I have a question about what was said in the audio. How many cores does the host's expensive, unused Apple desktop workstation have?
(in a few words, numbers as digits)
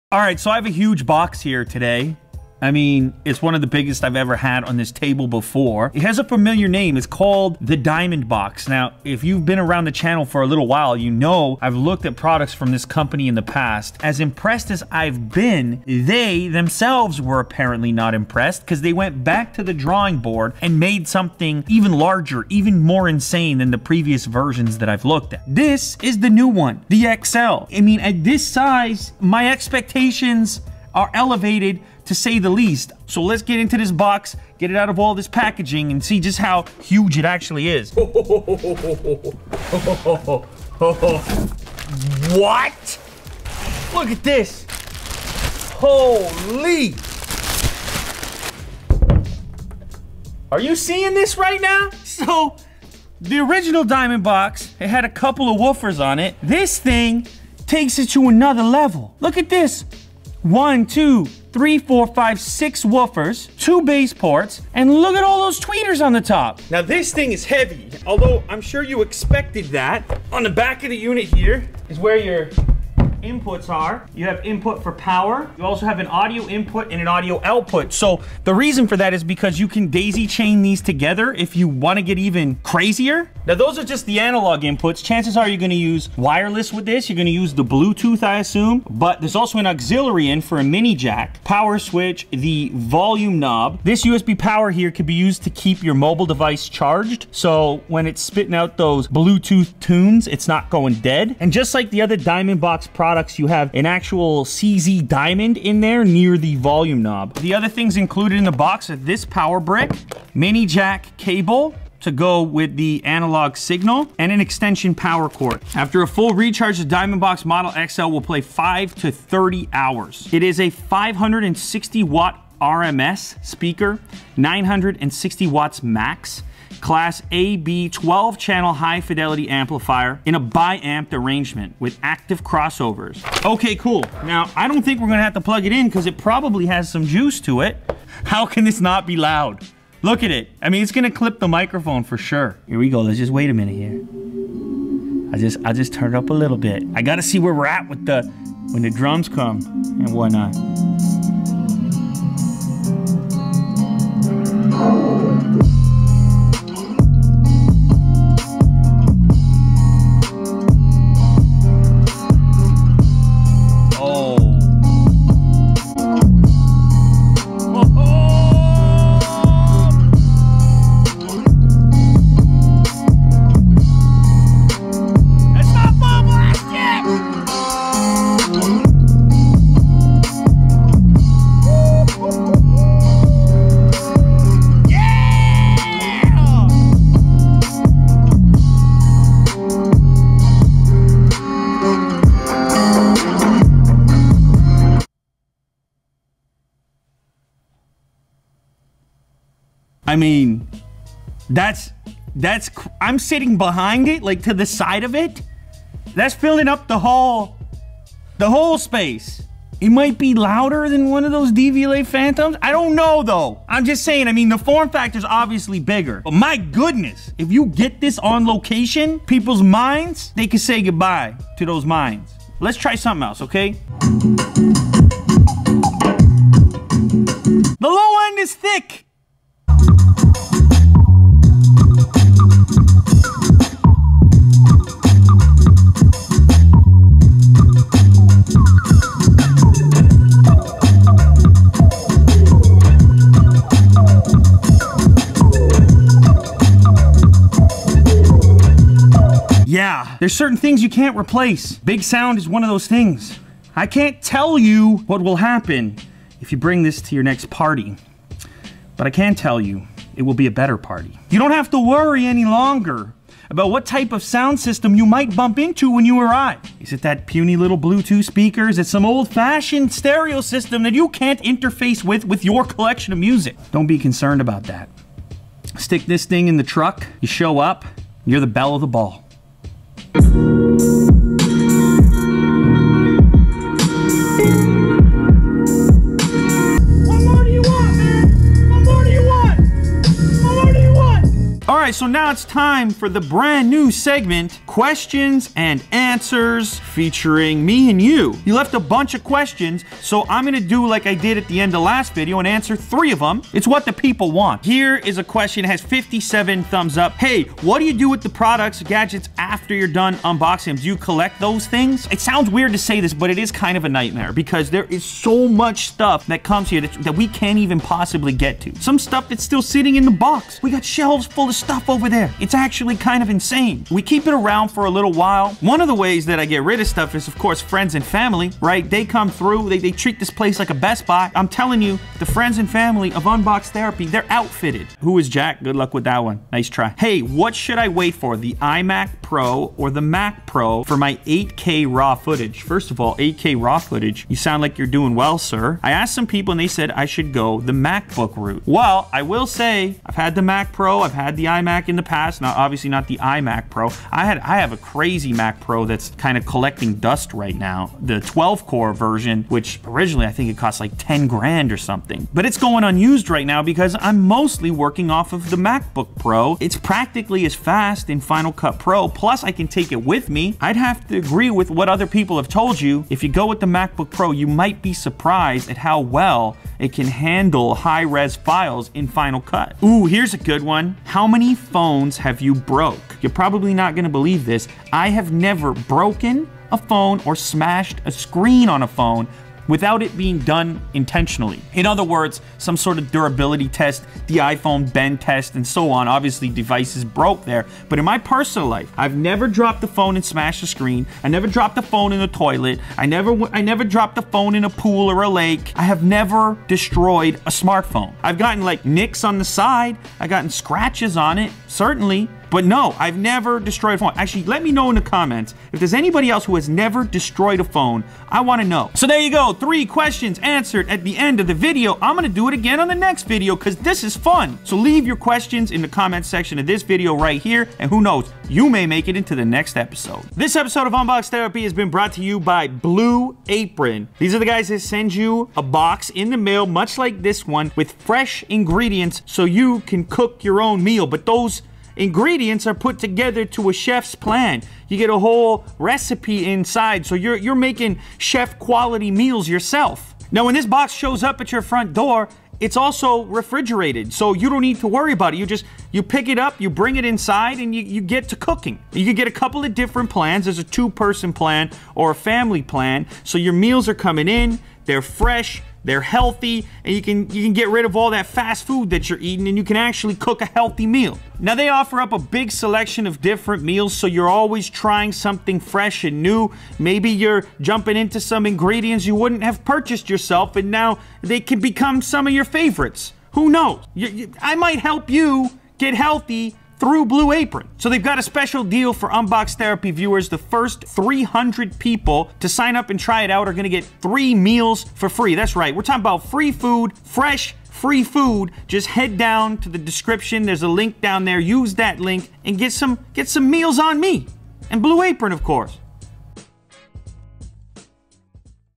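12.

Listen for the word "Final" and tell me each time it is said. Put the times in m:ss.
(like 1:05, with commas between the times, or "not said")
6:08, 6:19.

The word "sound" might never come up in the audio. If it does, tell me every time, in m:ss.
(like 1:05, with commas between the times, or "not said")
4:12, 4:24, 5:12, 5:44.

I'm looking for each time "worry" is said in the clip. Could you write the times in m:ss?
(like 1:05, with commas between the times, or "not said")
4:21, 7:34.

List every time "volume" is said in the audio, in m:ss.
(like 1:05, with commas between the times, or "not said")
1:32, 1:46.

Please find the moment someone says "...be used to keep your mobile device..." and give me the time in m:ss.
1:35.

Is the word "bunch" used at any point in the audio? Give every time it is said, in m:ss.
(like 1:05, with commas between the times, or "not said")
4:58.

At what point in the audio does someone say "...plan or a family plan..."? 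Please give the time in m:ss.
7:41.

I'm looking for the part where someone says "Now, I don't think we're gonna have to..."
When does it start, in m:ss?
2:14.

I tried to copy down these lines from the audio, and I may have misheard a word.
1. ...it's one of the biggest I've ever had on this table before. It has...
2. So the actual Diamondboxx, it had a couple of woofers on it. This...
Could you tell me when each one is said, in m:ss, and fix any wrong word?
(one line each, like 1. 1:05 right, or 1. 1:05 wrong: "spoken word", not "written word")
1. 0:03 right
2. 0:52 wrong: "original", not "actual".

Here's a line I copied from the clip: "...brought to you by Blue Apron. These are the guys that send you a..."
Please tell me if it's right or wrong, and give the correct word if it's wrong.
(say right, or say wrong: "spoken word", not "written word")
right.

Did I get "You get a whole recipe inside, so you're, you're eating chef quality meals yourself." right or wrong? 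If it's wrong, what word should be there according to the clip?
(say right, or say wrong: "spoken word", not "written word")
wrong: "making", not "eating".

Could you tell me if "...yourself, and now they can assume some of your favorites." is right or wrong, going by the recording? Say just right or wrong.
wrong.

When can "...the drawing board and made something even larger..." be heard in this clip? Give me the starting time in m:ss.
0:19.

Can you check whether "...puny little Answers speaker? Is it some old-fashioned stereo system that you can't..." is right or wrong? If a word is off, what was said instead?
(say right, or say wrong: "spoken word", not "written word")
wrong: "Bluetooth", not "Answers".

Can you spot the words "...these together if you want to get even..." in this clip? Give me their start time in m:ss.
1:20.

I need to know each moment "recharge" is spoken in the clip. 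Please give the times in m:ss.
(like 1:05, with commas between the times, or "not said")
1:56.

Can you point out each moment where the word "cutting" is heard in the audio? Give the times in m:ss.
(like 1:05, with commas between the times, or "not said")
not said.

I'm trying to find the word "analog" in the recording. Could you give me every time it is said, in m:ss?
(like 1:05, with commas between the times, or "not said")
1:24, 1:53.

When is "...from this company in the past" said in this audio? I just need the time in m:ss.
0:12.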